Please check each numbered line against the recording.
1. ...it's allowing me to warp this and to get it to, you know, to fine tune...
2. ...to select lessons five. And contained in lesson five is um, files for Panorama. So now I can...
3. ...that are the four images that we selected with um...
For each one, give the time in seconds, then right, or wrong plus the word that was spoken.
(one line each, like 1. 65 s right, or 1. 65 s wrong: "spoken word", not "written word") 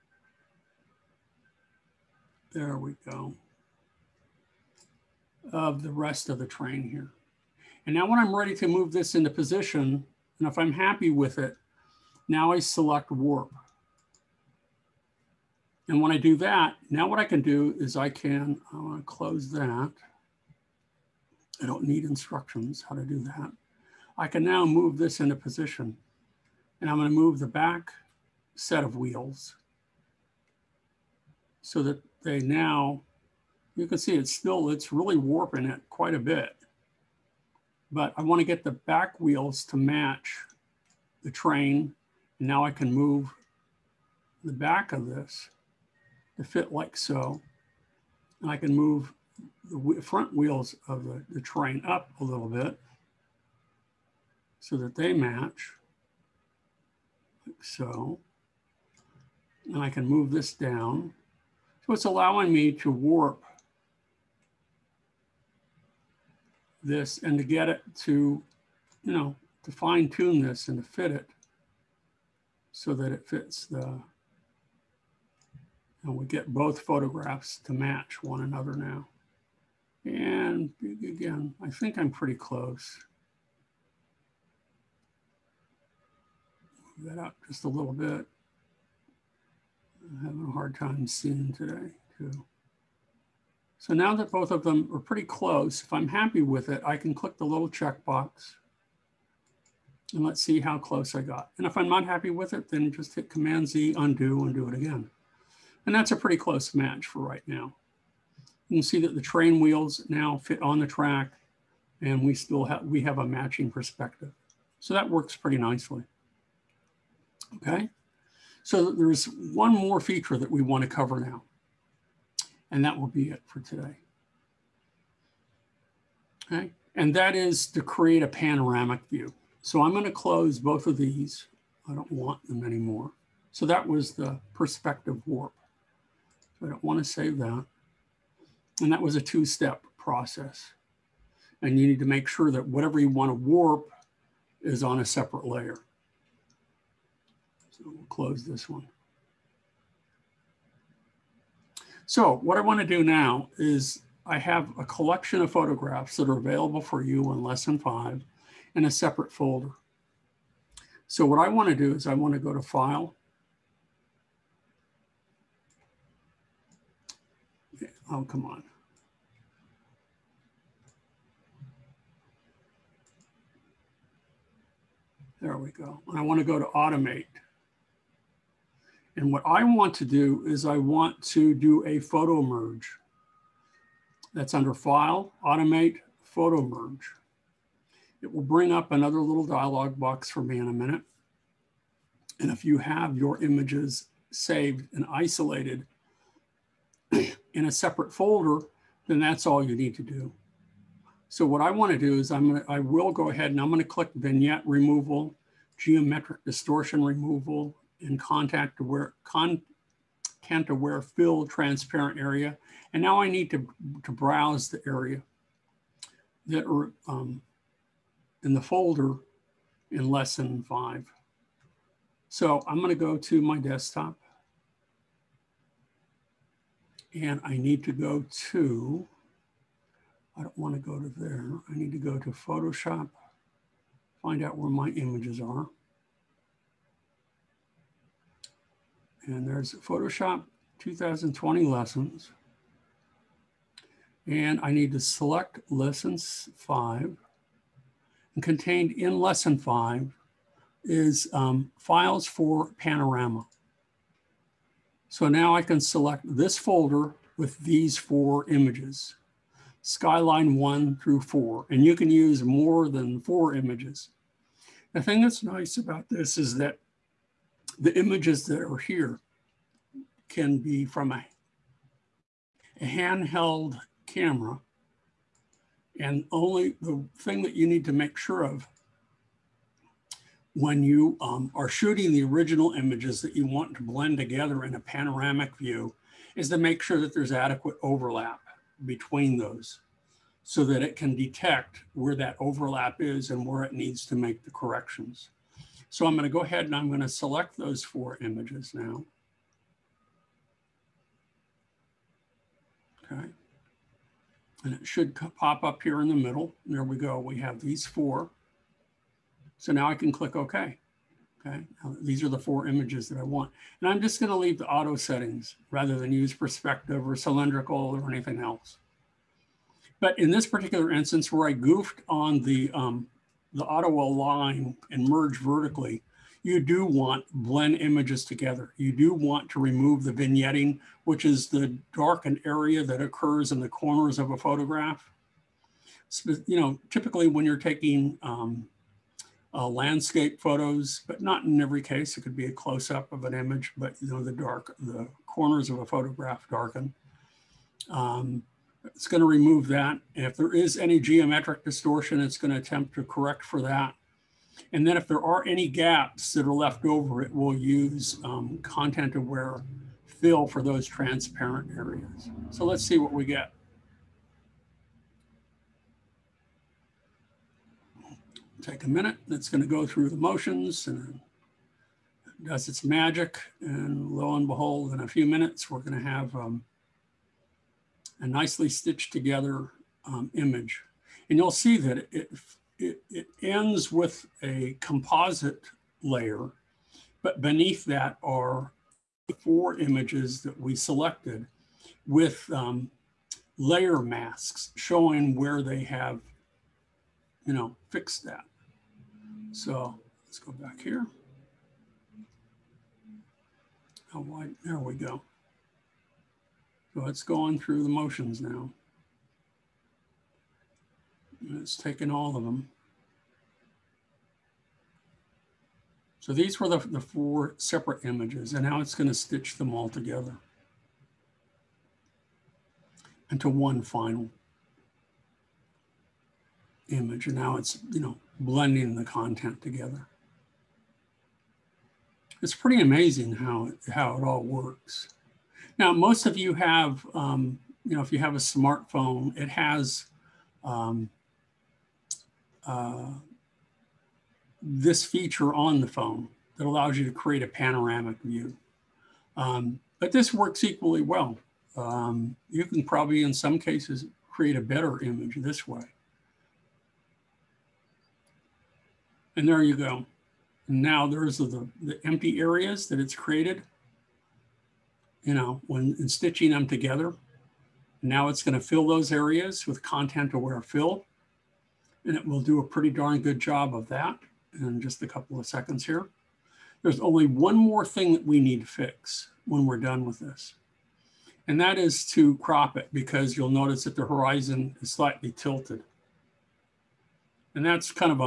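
1. 61 s right
2. 244 s right
3. 387 s right.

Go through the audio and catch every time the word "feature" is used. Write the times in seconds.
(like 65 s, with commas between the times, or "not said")
120 s, 445 s.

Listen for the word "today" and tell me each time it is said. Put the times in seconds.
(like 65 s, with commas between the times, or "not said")
91 s, 123 s.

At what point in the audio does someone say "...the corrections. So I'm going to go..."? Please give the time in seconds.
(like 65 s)
294 s.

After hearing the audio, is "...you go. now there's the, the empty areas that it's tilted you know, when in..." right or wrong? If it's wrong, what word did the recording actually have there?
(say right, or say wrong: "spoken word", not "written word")
wrong: "created", not "tilted".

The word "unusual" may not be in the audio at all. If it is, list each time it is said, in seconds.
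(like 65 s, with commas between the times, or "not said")
not said.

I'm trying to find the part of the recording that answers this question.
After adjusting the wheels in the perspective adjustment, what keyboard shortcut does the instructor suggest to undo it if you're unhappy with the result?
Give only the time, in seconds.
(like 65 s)
103 s.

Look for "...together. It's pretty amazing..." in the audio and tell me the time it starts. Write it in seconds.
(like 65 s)
429 s.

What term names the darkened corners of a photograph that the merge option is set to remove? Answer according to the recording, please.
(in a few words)
vignetting.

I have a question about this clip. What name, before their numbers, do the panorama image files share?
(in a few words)
skyline.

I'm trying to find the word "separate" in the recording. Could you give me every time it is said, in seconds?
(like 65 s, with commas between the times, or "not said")
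145 s, 158 s, 197 s, 417 s.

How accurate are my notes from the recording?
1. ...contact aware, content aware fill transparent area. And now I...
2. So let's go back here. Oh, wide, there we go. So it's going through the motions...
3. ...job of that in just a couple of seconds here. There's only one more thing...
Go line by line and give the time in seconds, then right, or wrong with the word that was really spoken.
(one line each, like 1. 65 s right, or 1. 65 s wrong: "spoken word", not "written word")
1. 208 s right
2. 399 s right
3. 473 s right.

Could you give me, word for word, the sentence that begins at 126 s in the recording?
Okay, and that is to create a panoramic view.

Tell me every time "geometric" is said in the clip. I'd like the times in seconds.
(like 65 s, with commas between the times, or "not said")
205 s, 351 s.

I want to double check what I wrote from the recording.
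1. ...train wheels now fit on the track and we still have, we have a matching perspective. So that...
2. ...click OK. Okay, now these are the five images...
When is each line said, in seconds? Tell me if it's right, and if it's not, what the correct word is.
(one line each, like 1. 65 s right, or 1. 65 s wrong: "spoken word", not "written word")
1. 109 s right
2. 310 s wrong: "four", not "five".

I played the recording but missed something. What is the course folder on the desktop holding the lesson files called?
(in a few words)
Photoshop 2020 lessons.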